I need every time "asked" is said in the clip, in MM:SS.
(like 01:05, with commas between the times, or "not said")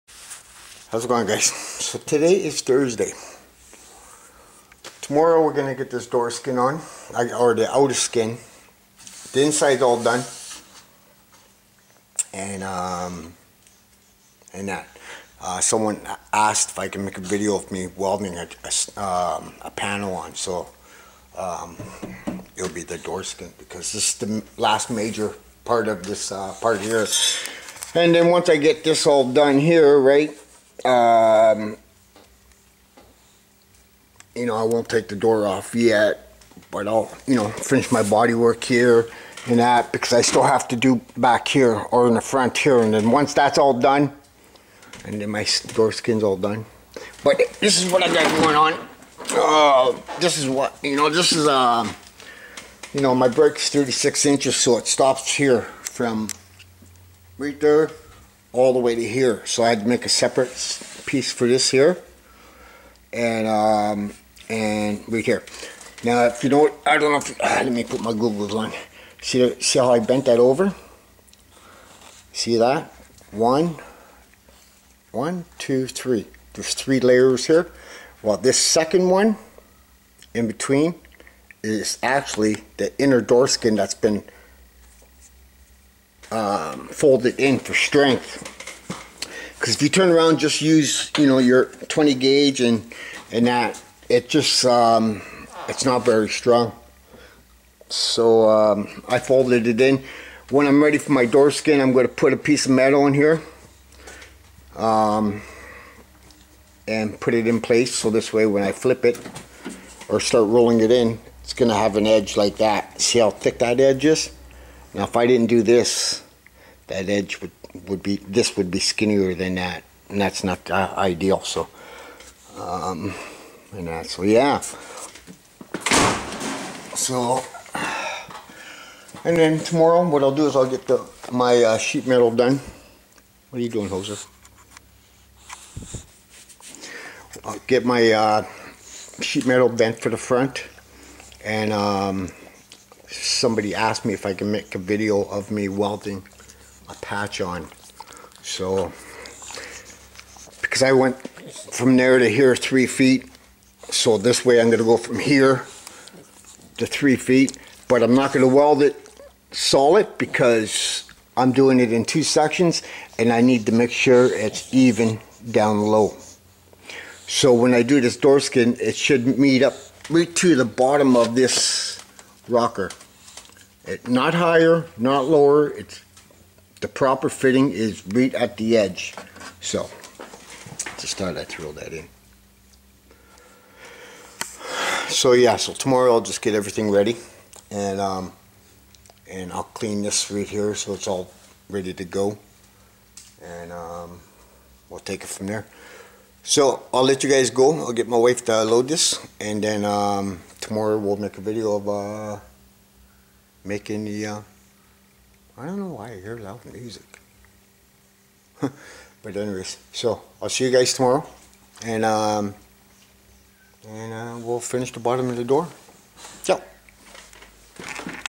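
00:16, 02:23.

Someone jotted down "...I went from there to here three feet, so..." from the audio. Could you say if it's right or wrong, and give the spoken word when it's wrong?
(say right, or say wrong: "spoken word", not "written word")
right.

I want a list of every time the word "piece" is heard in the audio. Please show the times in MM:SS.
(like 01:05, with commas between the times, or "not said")
01:01, 01:42.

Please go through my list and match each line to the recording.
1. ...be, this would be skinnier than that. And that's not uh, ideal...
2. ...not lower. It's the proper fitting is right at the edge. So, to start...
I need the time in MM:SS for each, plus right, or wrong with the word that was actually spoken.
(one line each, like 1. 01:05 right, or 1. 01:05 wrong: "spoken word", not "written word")
1. 01:58 right
2. 02:54 right.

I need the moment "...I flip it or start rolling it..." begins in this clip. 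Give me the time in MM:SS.
01:48.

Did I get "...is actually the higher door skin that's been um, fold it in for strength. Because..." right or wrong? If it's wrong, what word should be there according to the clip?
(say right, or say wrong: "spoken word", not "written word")
wrong: "inner", not "higher".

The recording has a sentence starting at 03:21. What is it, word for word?
Uh, Making the uh, I don't know why I hear loud music.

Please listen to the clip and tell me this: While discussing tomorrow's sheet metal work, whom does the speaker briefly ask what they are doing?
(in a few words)
Jose.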